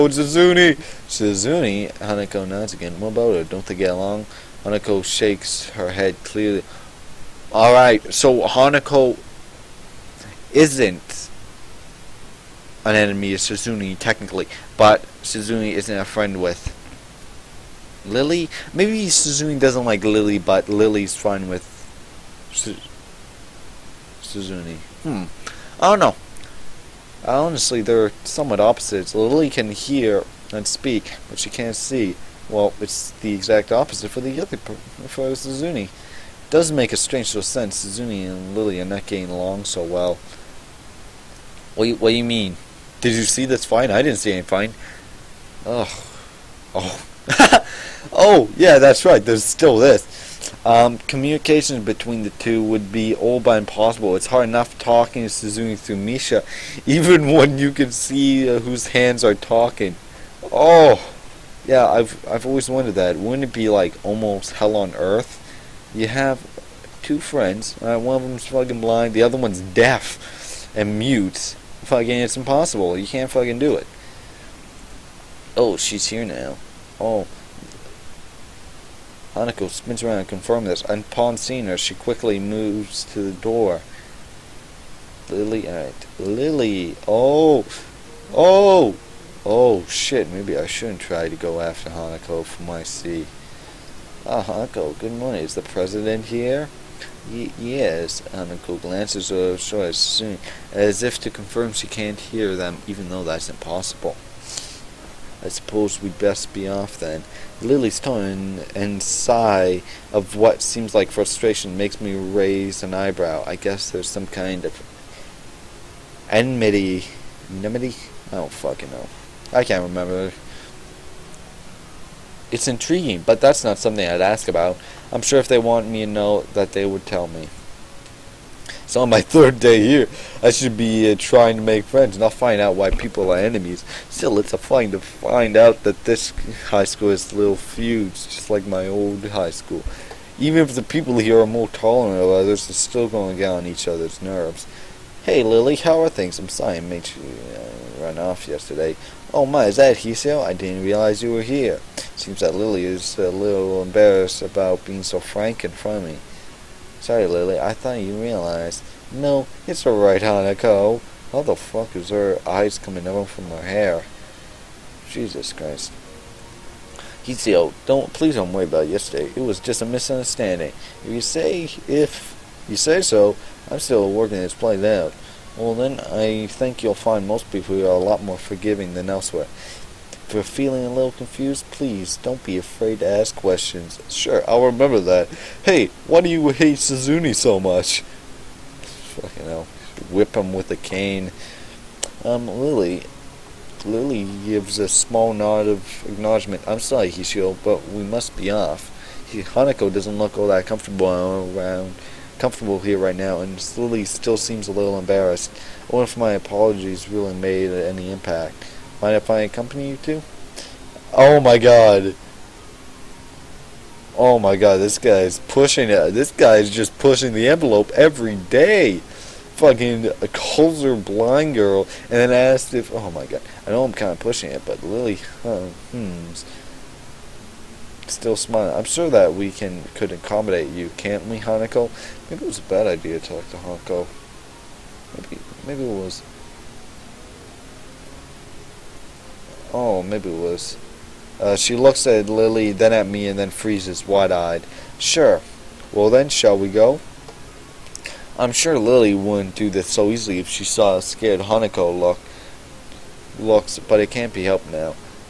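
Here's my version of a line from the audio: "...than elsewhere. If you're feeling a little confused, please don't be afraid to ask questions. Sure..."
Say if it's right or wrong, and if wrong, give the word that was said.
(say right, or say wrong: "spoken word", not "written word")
right.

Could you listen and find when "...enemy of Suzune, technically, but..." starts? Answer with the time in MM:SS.
00:12.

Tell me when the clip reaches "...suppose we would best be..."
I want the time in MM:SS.
01:45.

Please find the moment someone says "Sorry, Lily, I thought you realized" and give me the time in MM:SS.
02:37.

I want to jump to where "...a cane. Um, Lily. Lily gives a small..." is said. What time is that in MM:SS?
03:10.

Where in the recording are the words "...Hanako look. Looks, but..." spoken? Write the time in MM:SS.
04:11.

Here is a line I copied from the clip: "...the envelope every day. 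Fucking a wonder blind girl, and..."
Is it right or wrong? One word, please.
wrong.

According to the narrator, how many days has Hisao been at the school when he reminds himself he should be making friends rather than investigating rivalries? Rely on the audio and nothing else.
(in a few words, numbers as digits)
3.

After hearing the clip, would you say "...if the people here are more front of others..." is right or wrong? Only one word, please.
wrong.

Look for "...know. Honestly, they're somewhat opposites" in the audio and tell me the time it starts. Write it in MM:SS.
00:25.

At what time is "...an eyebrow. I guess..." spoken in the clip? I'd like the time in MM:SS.
01:52.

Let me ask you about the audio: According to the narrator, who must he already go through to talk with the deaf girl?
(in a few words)
Misha.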